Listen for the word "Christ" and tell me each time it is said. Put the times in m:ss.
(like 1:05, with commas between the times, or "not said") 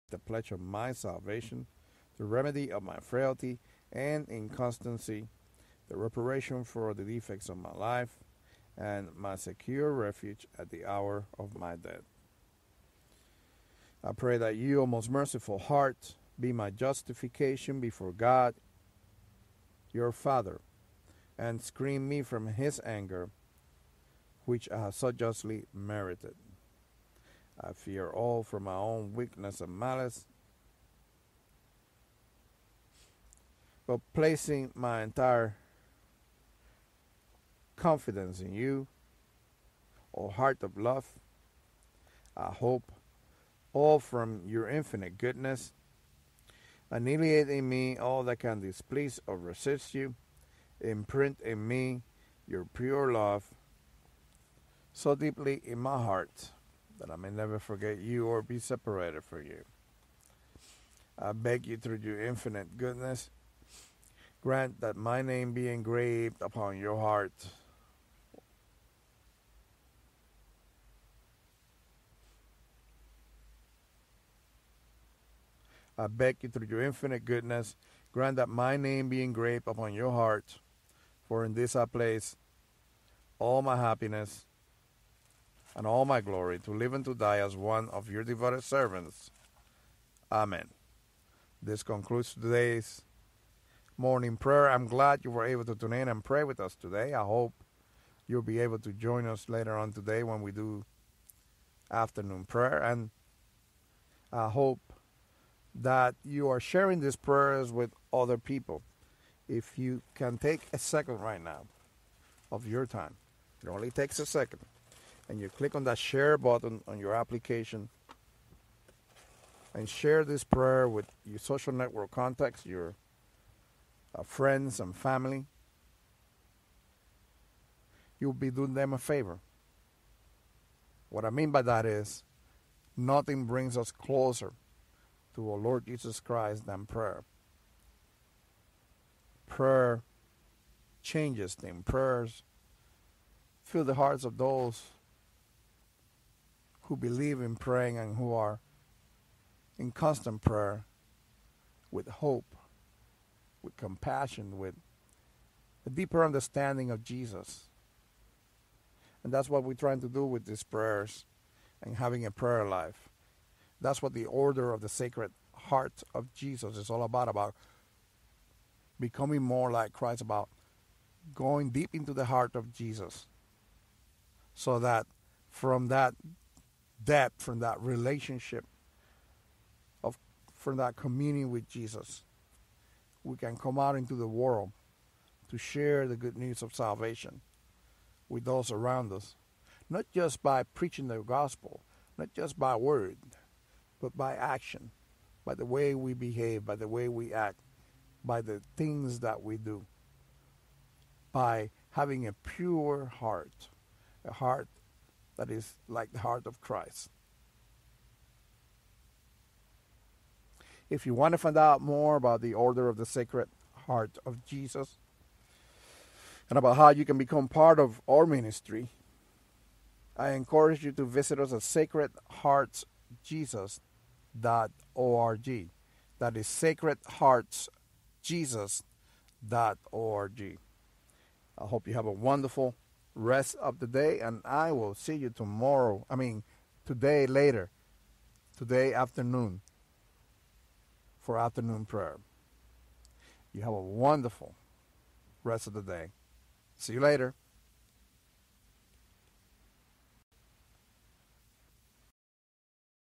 2:16, 2:49, 3:26.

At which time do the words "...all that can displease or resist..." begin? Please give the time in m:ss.
0:47.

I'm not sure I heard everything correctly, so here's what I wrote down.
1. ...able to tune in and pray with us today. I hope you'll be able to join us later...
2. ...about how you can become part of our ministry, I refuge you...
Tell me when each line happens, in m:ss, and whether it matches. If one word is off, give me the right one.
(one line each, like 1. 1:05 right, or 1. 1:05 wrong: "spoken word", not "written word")
1. 1:35 right
2. 3:36 wrong: "encourage", not "refuge".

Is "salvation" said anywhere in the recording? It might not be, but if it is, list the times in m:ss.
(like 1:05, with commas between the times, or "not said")
0:00, 3:06.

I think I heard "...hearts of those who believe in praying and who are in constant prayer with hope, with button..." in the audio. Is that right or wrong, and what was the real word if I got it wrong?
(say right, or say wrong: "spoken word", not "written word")
wrong: "compassion", not "button".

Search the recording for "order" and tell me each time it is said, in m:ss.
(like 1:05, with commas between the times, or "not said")
2:44, 3:32.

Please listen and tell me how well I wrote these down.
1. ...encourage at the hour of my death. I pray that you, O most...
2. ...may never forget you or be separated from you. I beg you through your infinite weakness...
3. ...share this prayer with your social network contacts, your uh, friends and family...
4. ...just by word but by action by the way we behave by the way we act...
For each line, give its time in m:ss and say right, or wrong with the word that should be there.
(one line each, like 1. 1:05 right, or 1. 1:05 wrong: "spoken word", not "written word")
1. 0:09 wrong: "refuge", not "encourage"
2. 0:57 wrong: "goodness", not "weakness"
3. 1:59 right
4. 3:12 right.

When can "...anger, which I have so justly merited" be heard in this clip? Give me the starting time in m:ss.
0:22.